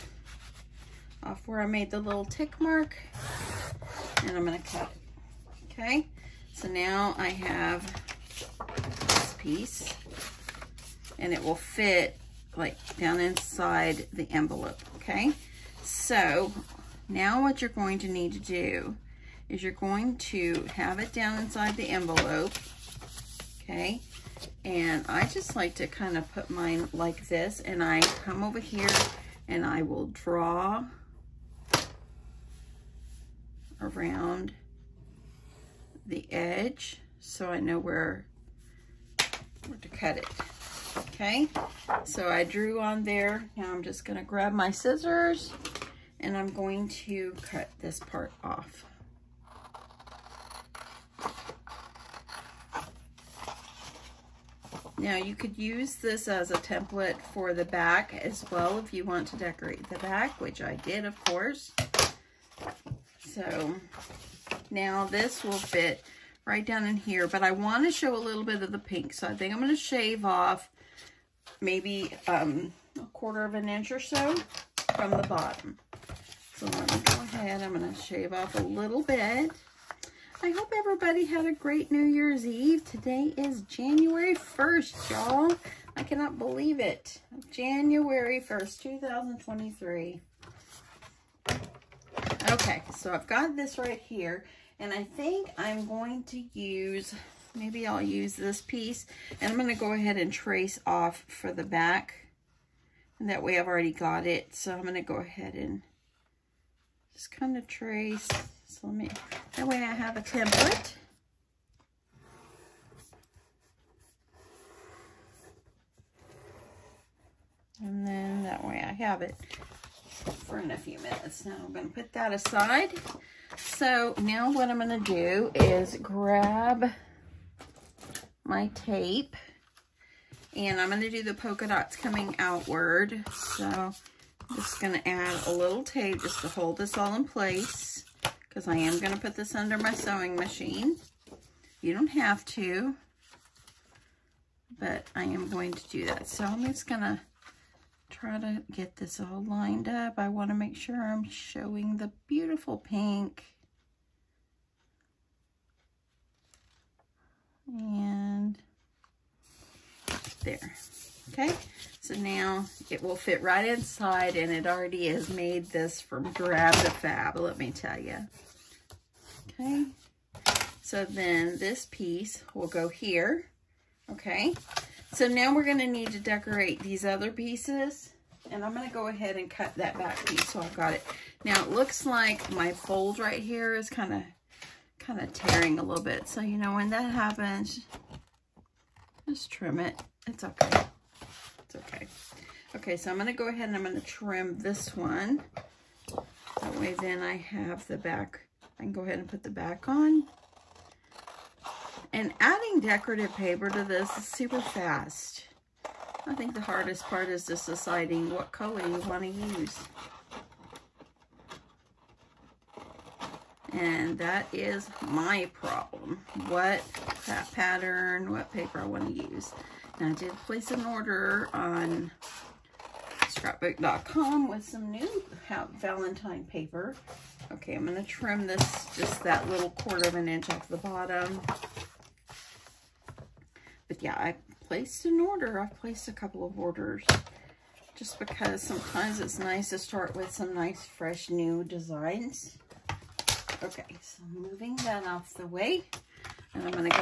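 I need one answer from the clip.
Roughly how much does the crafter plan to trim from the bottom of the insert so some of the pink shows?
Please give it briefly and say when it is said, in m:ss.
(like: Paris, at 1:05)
a quarter of an inch, at 1:12.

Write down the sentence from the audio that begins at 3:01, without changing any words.
Now it looks like my fold right here is kind of kind of tearing a little bit.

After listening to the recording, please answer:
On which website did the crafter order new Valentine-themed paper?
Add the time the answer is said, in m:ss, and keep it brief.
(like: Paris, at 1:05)
scrapbook.com, at 3:43.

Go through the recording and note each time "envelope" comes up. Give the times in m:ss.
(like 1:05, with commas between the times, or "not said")
0:14, 0:21.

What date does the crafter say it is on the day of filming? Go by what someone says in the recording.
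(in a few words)
January 1st, 2023.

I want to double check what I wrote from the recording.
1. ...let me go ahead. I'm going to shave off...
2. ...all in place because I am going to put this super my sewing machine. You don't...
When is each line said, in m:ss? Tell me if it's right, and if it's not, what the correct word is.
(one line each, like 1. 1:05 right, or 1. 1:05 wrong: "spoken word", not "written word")
1. 1:16 right
2. 2:16 wrong: "under", not "super".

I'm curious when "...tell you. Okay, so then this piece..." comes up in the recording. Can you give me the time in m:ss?
2:47.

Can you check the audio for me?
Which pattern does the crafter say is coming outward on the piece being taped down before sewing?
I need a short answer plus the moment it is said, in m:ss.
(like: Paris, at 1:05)
polka dots, at 2:11.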